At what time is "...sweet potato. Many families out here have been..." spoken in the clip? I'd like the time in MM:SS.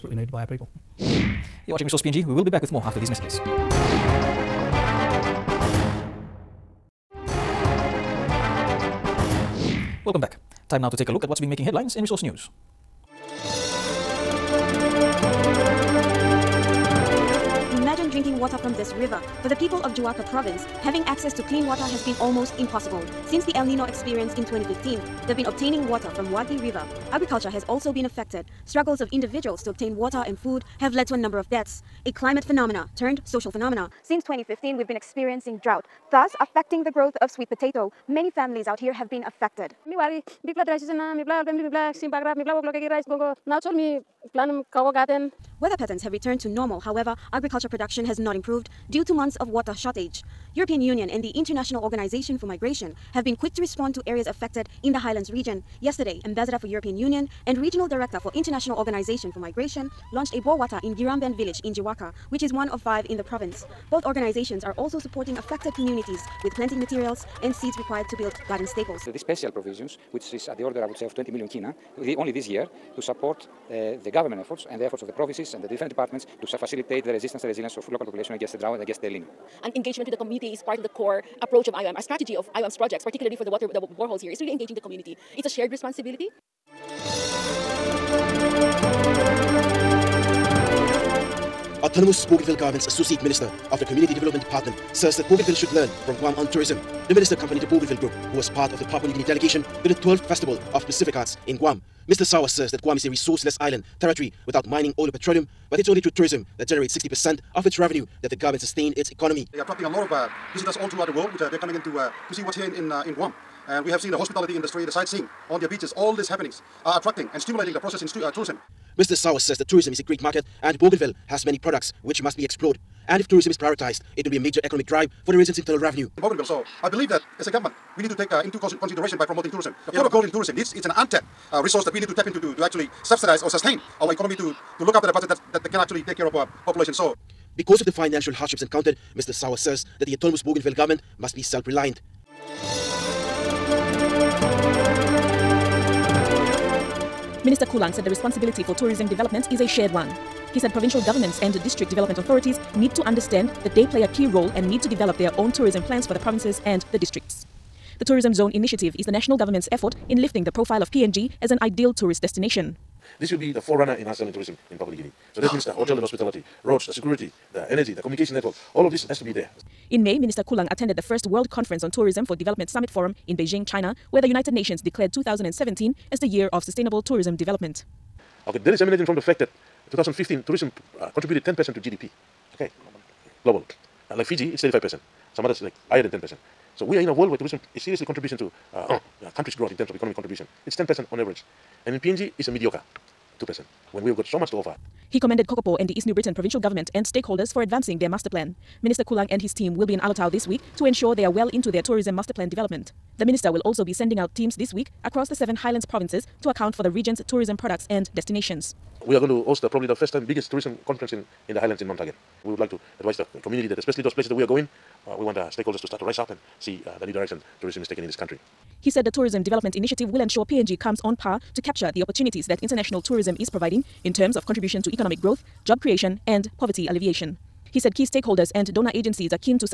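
00:37.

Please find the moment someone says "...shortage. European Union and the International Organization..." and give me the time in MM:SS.
00:49.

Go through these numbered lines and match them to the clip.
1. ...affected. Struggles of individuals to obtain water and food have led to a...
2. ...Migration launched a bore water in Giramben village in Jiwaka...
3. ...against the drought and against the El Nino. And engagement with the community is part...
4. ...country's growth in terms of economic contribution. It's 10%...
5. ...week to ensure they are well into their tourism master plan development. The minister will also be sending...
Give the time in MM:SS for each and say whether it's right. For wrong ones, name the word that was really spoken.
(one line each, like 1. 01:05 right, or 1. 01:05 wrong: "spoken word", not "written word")
1. 00:28 right
2. 00:59 right
3. 01:18 right
4. 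03:09 right
5. 03:20 right.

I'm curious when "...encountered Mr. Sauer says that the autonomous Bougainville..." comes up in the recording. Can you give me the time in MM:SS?
02:18.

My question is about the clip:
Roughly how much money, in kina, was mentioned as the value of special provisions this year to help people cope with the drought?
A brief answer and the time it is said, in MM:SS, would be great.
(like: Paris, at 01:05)
20 million kina, at 01:11.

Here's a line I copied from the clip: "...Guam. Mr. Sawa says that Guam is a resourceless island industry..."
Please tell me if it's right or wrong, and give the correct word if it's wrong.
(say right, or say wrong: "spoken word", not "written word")
wrong: "territory", not "industry".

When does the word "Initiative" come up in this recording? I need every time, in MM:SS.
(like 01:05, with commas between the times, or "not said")
02:38, 03:39.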